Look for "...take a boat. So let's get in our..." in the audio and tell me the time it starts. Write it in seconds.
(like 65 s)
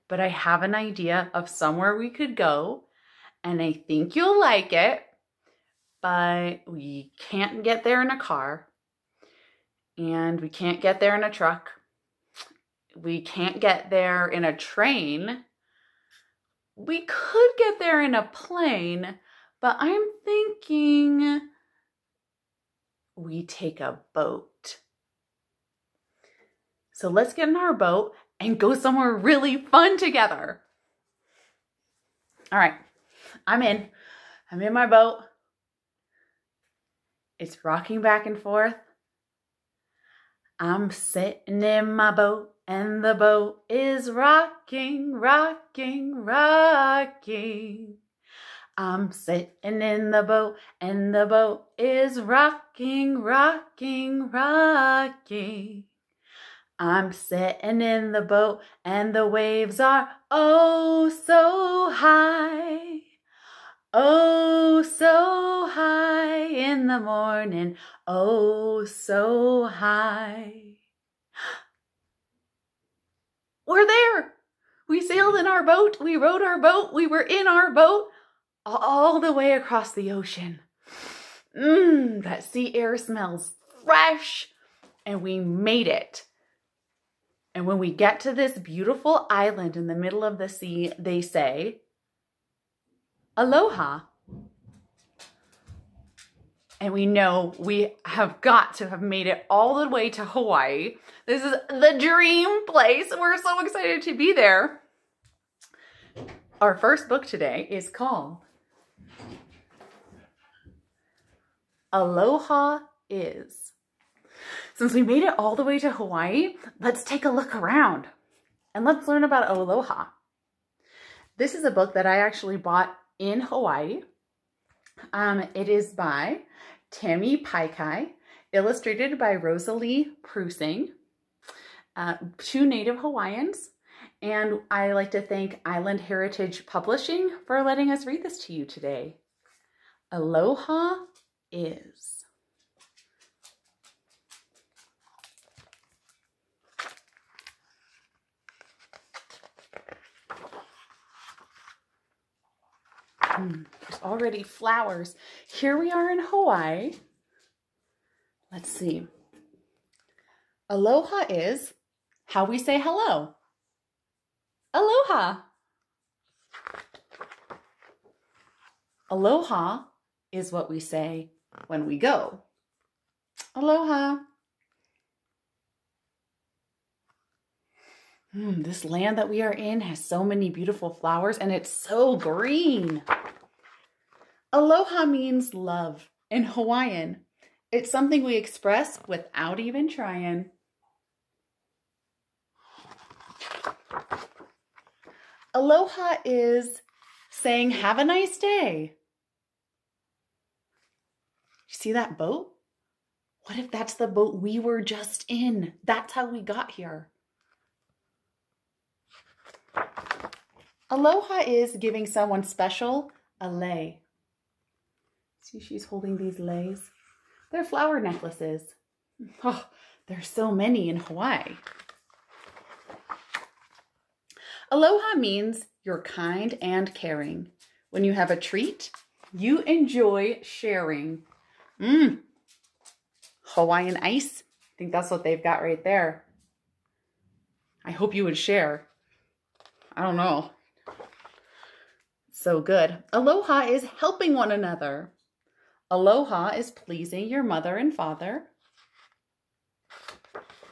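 23 s.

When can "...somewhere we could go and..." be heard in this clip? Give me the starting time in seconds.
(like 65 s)
1 s.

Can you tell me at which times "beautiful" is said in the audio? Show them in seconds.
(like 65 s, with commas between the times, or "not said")
88 s, 180 s.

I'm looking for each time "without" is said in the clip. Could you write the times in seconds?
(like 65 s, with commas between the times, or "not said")
189 s.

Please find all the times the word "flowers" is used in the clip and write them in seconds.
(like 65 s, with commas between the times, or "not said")
154 s, 180 s, 217 s.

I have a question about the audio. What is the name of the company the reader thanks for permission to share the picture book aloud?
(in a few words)
Island Heritage Publishing.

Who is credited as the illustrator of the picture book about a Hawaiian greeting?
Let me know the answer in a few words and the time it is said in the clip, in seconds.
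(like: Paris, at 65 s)
Rosalie Prussing, at 129 s.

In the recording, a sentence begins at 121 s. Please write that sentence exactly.
This is a book that I actually bought in Hawaii.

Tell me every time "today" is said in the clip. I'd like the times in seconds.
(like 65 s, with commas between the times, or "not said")
107 s, 138 s.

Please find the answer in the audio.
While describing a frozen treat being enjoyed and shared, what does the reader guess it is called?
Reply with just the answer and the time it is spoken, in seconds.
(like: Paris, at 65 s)
Hawaiian ice, at 233 s.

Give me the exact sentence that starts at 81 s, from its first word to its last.
Mmm, that sea air smells fresh.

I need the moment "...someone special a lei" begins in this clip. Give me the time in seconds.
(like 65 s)
212 s.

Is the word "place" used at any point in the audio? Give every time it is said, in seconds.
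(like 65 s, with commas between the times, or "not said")
102 s.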